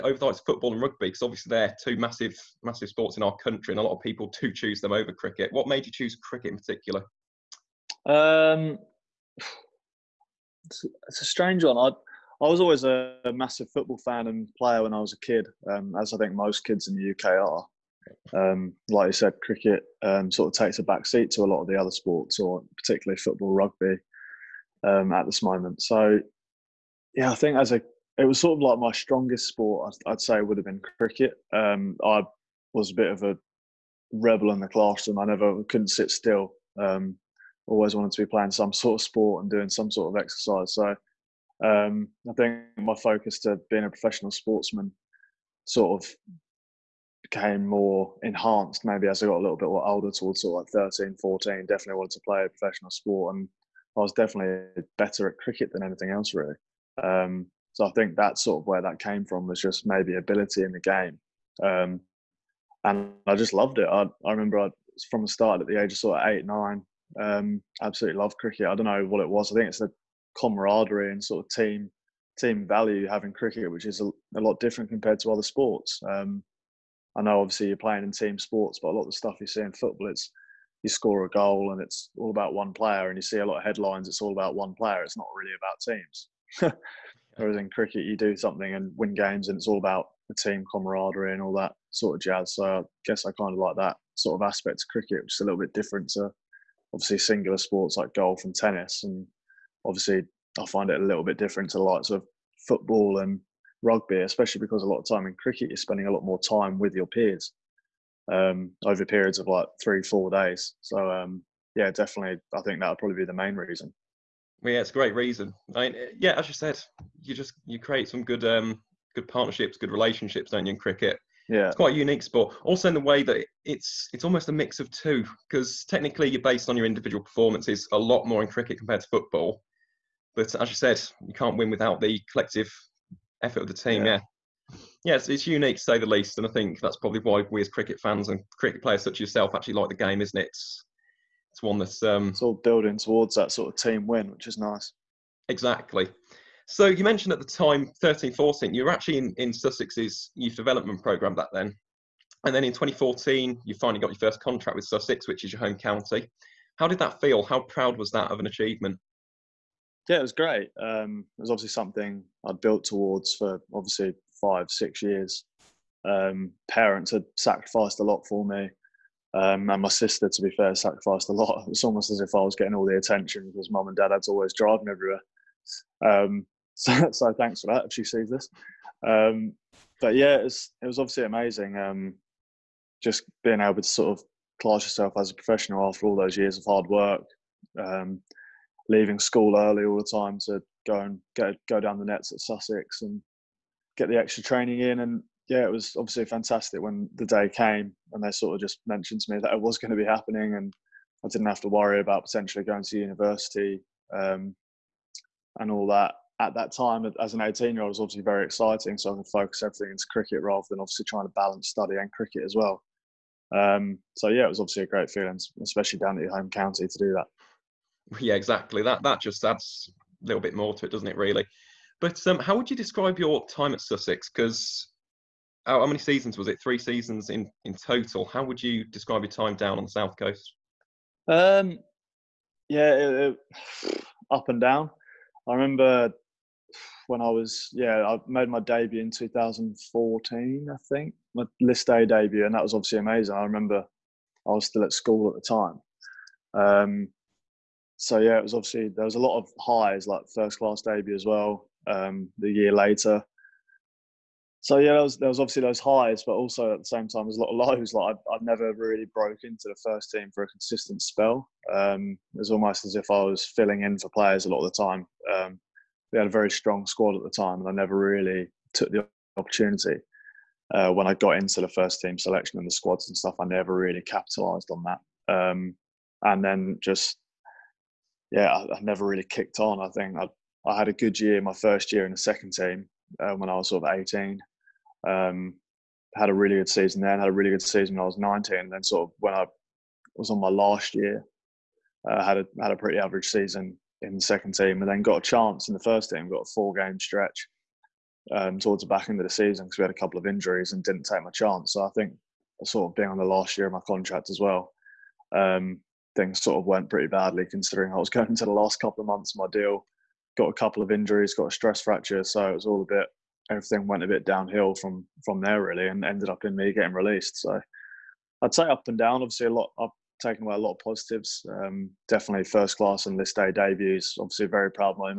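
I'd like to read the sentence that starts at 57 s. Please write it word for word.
Um, so I think that's sort of where that came from was just maybe ability in the game.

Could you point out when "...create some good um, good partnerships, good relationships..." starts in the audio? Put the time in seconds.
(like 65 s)
117 s.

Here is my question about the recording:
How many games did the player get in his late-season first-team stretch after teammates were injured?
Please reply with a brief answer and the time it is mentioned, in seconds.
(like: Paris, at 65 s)
4, at 296 s.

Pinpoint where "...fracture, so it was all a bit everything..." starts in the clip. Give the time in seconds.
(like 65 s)
311 s.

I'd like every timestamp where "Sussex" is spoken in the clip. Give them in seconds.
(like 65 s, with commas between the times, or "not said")
149 s, 154 s, 192 s, 223 s.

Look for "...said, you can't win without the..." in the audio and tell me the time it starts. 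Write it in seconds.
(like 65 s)
130 s.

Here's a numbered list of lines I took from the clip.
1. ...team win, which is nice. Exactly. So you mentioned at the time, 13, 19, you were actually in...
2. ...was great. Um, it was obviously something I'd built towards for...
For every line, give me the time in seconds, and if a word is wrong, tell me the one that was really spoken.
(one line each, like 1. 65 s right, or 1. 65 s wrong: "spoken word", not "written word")
1. 143 s wrong: "14", not "19"
2. 160 s right.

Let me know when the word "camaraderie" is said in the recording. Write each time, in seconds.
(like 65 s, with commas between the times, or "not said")
70 s, 90 s.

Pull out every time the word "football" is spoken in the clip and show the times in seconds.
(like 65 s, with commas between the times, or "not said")
0 s, 13 s, 23 s, 79 s, 102 s, 129 s.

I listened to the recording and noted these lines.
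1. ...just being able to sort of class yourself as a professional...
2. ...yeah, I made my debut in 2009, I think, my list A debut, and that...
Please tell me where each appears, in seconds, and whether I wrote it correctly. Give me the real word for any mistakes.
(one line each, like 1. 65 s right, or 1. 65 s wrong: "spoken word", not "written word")
1. 183 s right
2. 237 s wrong: "2014", not "2009".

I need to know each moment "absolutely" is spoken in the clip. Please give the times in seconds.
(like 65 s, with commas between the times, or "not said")
67 s.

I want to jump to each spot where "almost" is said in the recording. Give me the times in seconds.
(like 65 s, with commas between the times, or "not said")
124 s, 171 s, 262 s.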